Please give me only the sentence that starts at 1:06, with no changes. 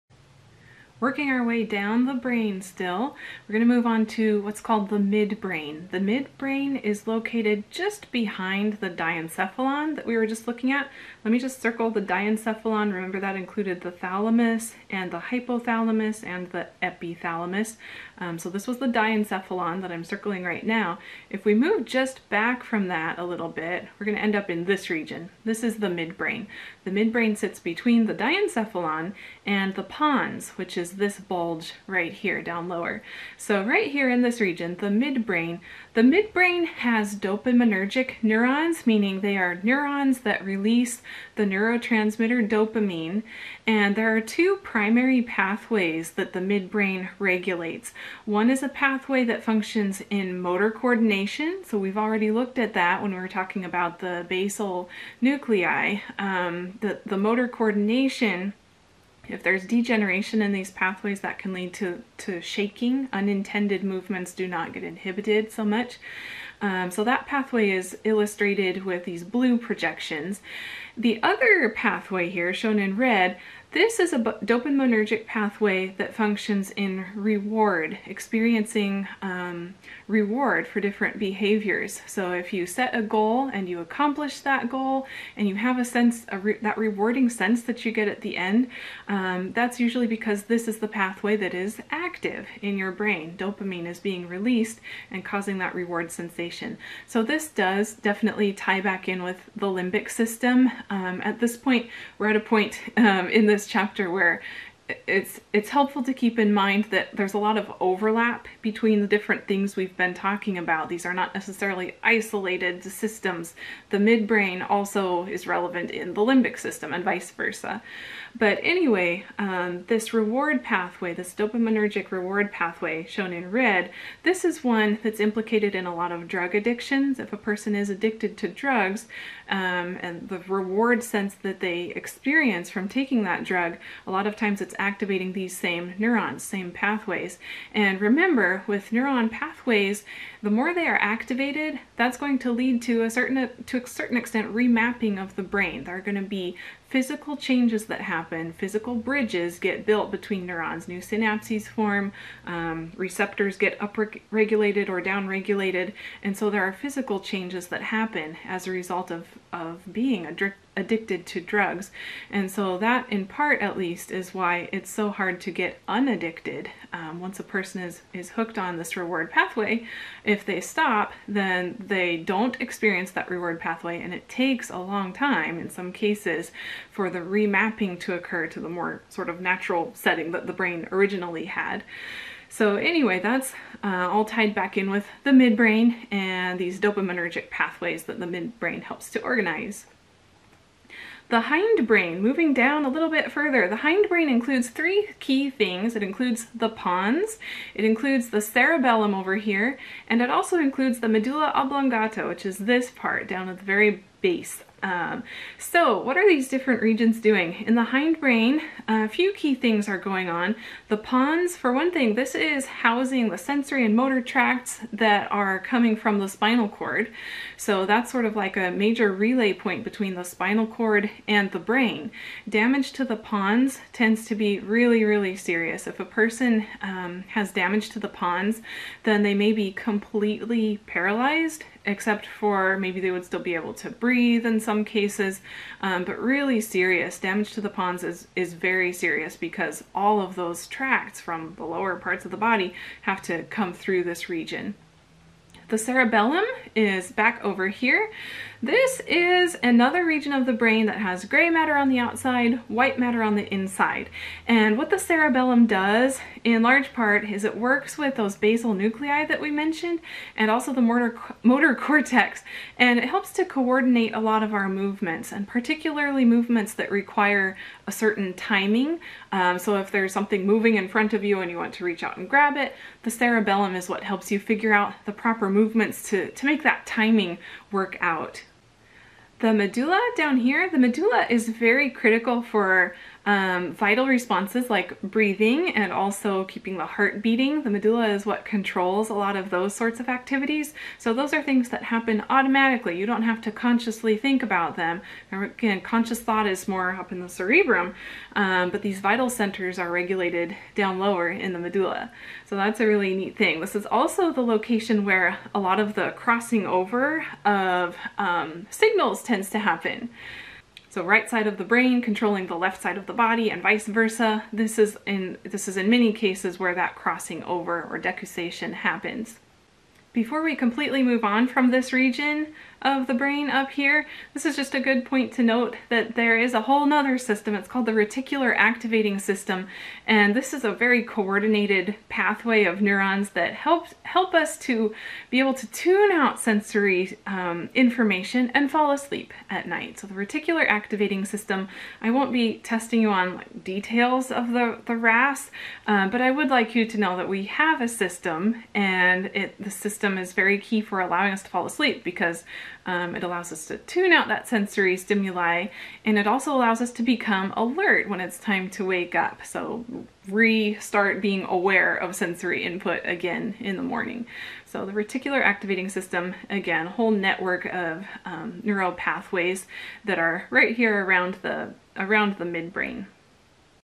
Um, so that pathway is illustrated with these blue projections.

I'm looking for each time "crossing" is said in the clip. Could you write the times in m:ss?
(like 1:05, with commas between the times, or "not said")
5:06, 5:16.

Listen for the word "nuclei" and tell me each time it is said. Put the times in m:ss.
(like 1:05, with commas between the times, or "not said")
0:55, 4:18.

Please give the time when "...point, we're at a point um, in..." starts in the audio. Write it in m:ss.
1:41.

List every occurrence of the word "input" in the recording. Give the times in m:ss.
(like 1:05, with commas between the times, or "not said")
6:02.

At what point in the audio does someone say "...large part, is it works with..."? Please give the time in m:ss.
4:16.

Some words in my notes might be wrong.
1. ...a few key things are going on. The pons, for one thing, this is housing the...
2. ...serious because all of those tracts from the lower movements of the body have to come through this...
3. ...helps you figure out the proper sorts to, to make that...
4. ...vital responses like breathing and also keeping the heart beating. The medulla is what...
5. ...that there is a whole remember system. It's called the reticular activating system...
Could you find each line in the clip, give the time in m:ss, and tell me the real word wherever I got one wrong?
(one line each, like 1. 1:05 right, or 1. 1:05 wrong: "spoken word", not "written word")
1. 3:28 right
2. 3:58 wrong: "parts", not "movements"
3. 4:34 wrong: "movements", not "sorts"
4. 4:43 right
5. 5:25 wrong: "nother", not "remember".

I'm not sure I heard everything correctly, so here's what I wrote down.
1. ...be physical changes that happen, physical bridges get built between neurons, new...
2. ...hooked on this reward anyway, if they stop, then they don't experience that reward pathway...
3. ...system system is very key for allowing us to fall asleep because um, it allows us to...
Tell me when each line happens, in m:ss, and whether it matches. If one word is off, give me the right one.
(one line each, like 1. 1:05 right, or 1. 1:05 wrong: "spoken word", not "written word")
1. 2:26 right
2. 2:48 wrong: "pathway", not "anyway"
3. 5:49 right.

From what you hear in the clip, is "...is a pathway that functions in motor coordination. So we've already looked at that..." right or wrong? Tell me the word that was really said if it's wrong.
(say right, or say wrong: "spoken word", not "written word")
right.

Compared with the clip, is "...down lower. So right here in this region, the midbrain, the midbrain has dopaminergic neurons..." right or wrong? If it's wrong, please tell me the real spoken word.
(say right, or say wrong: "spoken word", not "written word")
right.